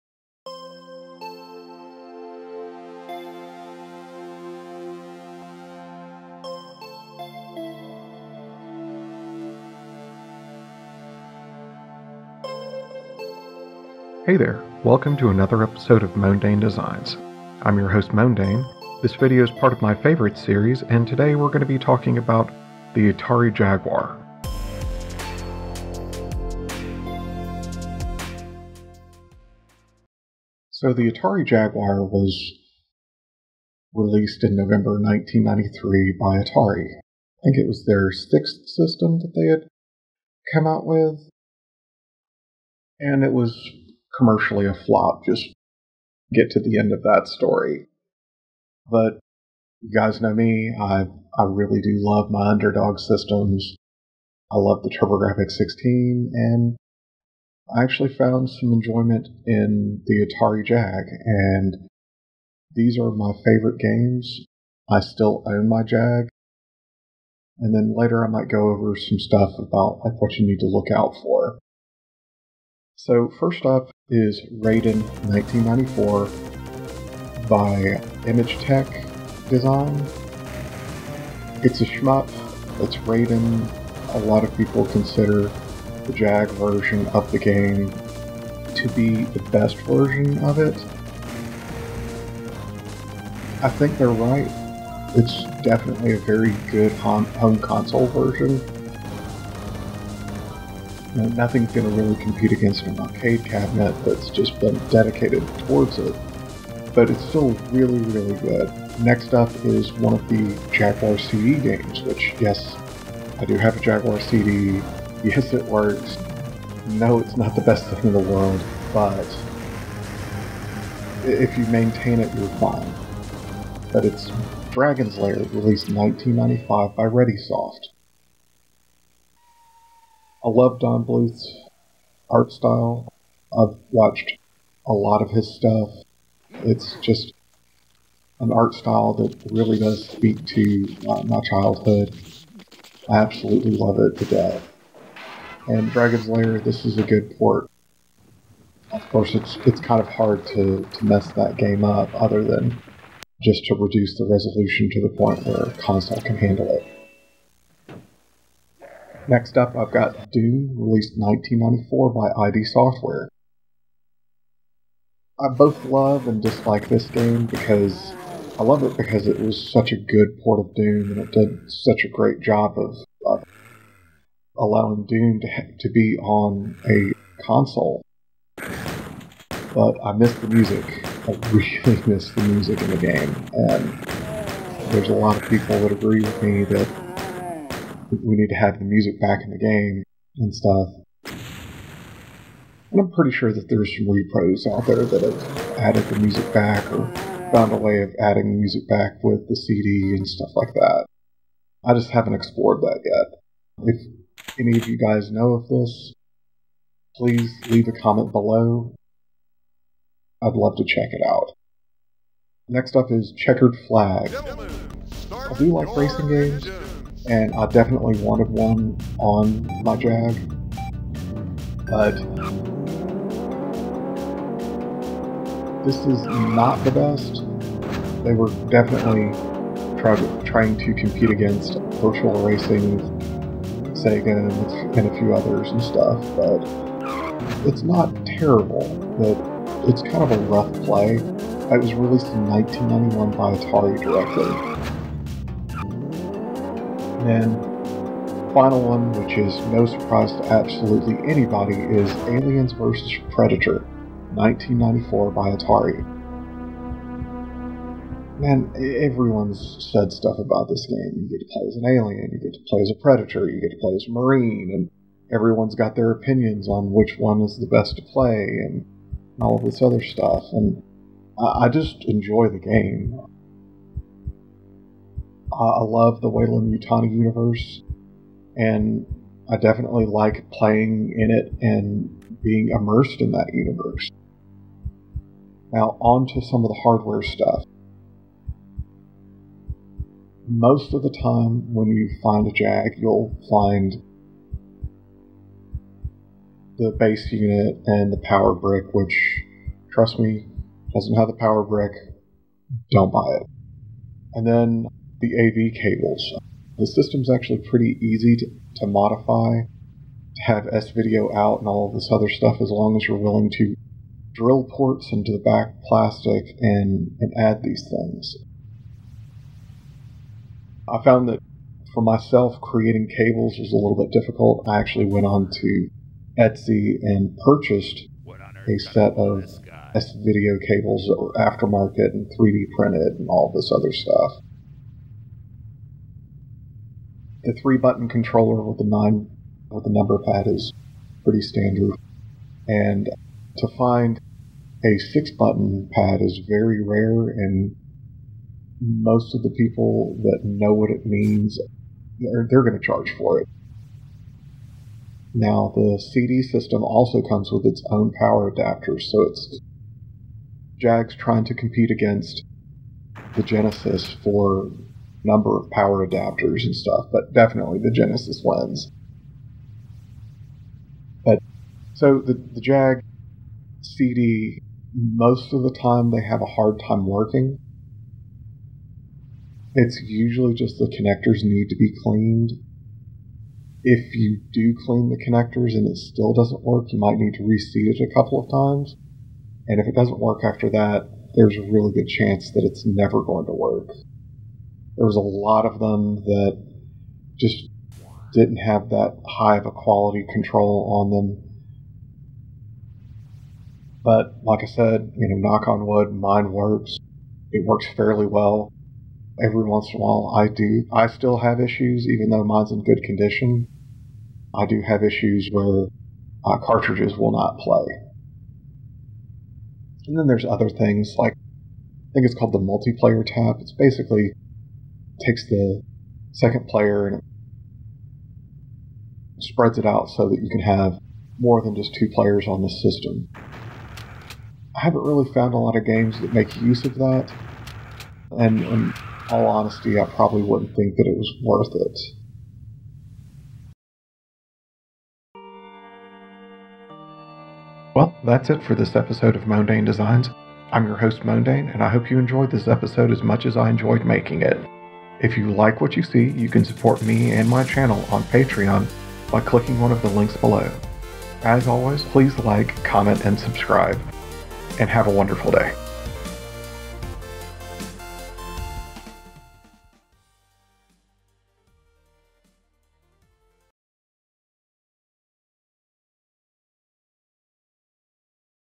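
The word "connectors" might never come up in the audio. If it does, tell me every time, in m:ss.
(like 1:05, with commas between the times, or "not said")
6:20, 6:25.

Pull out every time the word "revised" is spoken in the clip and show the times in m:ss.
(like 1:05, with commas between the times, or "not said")
not said.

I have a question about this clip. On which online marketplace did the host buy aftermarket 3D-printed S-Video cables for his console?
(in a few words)
Etsy.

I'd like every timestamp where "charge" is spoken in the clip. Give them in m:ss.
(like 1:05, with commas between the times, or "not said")
5:52.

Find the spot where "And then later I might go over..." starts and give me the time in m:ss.
1:07.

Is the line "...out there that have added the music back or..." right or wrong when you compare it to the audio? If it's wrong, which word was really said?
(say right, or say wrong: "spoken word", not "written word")
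right.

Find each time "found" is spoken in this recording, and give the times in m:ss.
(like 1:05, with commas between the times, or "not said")
0:58, 3:17, 5:21, 7:15.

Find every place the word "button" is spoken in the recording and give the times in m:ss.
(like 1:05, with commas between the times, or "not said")
5:37, 5:45.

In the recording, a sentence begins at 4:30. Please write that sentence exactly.
And I just enjoy the game.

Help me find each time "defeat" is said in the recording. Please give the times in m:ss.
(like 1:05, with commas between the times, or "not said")
not said.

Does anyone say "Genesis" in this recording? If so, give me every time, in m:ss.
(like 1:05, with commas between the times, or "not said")
6:03, 6:07.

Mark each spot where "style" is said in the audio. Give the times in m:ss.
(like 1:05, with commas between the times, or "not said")
2:12, 2:18.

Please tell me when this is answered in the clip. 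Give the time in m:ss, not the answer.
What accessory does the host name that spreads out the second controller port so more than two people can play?
7:02.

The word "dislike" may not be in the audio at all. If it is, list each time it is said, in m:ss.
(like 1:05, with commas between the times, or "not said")
2:46.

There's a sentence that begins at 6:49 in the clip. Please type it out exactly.
Every once in a while, I do.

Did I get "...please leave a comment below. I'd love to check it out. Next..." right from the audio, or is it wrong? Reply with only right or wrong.
right.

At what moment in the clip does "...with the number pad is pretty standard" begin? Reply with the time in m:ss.
5:39.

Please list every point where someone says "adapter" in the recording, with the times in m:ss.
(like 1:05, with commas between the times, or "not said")
5:58, 6:06.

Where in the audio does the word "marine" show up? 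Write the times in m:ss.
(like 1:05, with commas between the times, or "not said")
4:24.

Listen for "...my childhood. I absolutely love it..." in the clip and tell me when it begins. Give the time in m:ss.
2:21.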